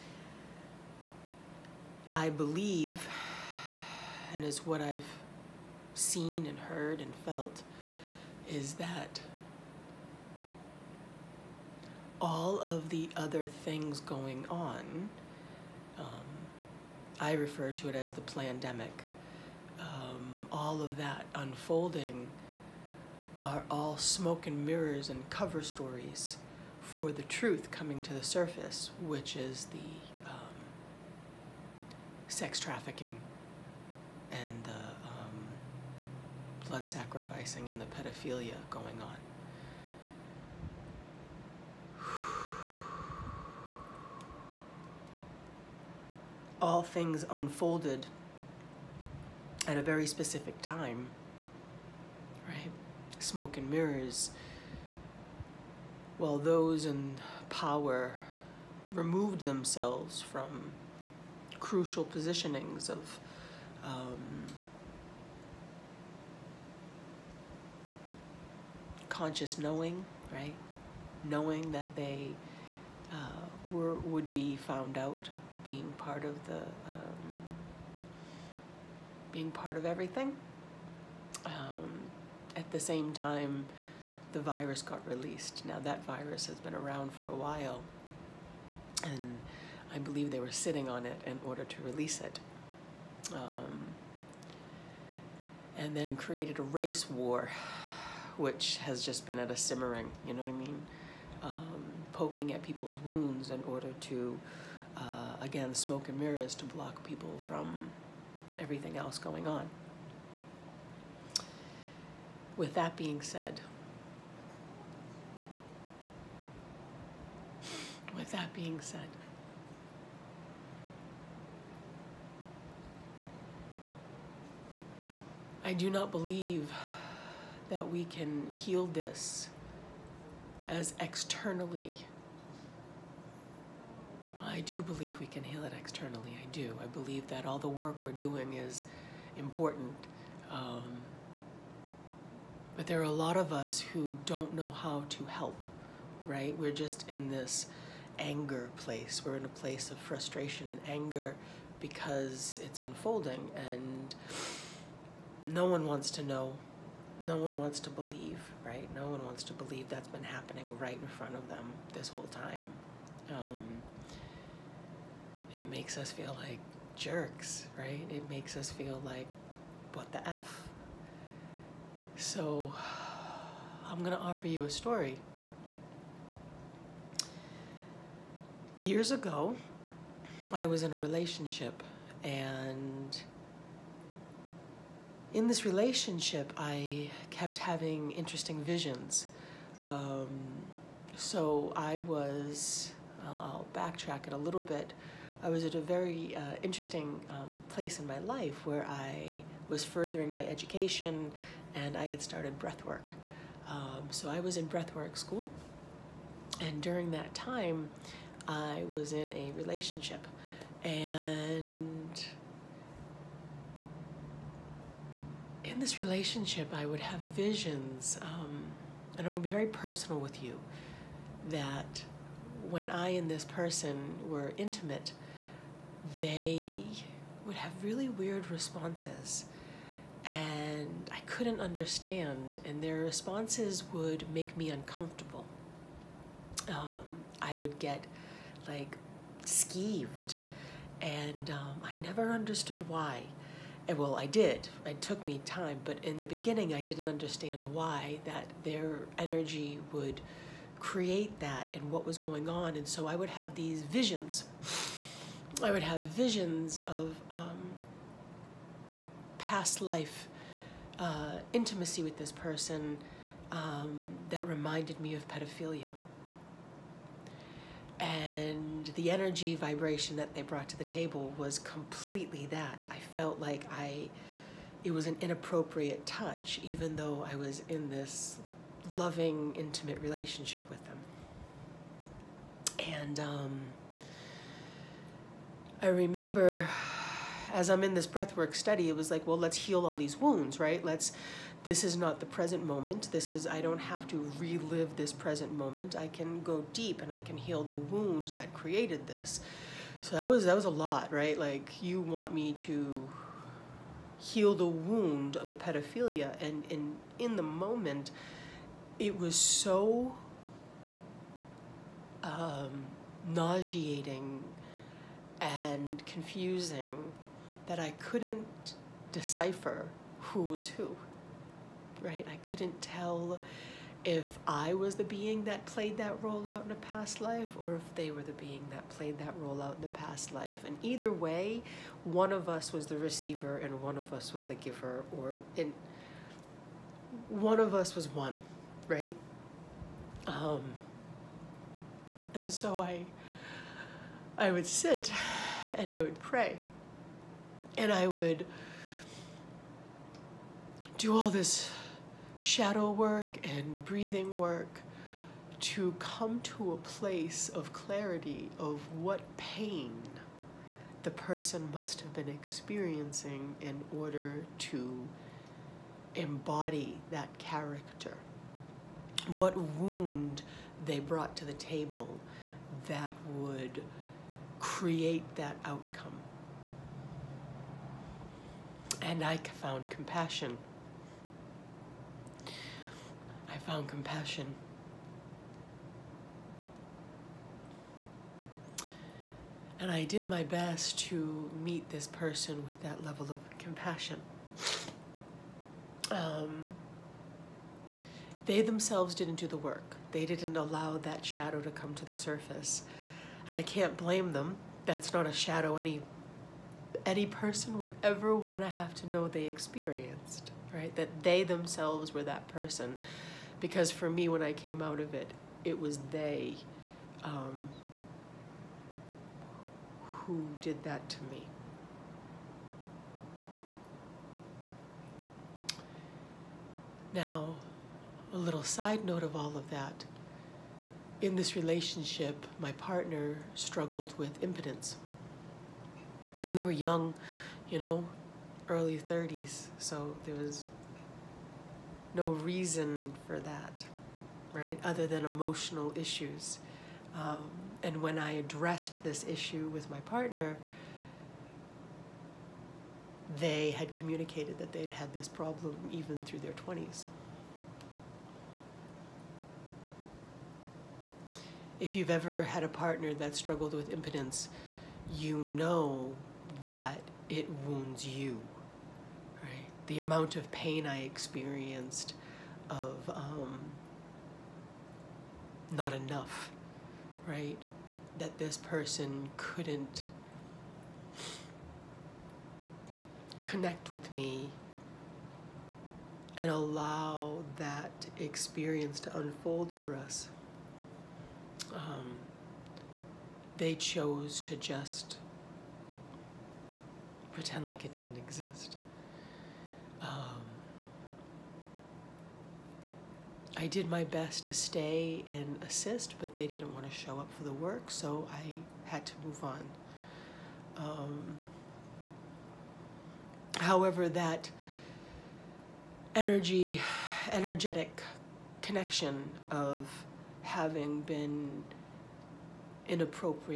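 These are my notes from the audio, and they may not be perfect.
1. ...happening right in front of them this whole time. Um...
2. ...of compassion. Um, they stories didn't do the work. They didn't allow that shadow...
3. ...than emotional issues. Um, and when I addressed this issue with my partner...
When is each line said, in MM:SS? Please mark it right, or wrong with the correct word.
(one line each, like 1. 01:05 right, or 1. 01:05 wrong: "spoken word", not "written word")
1. 02:40 right
2. 06:33 wrong: "themselves", not "stories"
3. 07:25 right.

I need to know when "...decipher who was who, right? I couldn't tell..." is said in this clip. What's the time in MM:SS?
05:19.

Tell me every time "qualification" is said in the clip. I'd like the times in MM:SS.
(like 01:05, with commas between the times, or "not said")
not said.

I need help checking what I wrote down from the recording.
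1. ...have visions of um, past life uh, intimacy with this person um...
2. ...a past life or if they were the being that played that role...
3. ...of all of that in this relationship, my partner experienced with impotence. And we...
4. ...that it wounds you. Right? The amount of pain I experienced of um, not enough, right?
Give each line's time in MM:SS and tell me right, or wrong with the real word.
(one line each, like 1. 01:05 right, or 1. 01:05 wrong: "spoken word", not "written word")
1. 04:15 right
2. 05:26 right
3. 07:09 wrong: "struggled", not "experienced"
4. 07:46 right.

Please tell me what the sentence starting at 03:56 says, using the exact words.
Um, I would get like skeeved, and um, I never understood why.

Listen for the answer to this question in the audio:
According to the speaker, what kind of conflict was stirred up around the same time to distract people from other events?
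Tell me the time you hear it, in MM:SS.
01:36.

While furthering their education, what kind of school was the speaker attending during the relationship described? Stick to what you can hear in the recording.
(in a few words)
breathwork school.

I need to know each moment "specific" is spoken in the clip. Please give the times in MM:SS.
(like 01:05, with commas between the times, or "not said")
00:50.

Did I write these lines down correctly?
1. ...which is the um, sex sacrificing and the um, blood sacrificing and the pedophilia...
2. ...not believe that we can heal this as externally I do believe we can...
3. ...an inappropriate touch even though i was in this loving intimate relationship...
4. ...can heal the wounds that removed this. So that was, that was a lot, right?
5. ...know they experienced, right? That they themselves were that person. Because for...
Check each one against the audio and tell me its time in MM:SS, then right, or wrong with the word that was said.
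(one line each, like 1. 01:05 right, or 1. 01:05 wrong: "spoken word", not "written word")
1. 00:29 wrong: "trafficking", not "sacrificing"
2. 02:05 right
3. 04:35 right
4. 04:57 wrong: "created", not "removed"
5. 06:49 right.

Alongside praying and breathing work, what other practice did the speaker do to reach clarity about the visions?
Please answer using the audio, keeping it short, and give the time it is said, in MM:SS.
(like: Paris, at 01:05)
shadow work, at 05:52.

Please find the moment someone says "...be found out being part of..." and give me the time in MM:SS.
01:14.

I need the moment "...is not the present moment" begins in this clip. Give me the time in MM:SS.
04:51.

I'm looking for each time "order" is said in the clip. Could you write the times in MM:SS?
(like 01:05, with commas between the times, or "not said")
01:31, 01:43, 06:03.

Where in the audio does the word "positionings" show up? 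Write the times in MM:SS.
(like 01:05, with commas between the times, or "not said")
01:02.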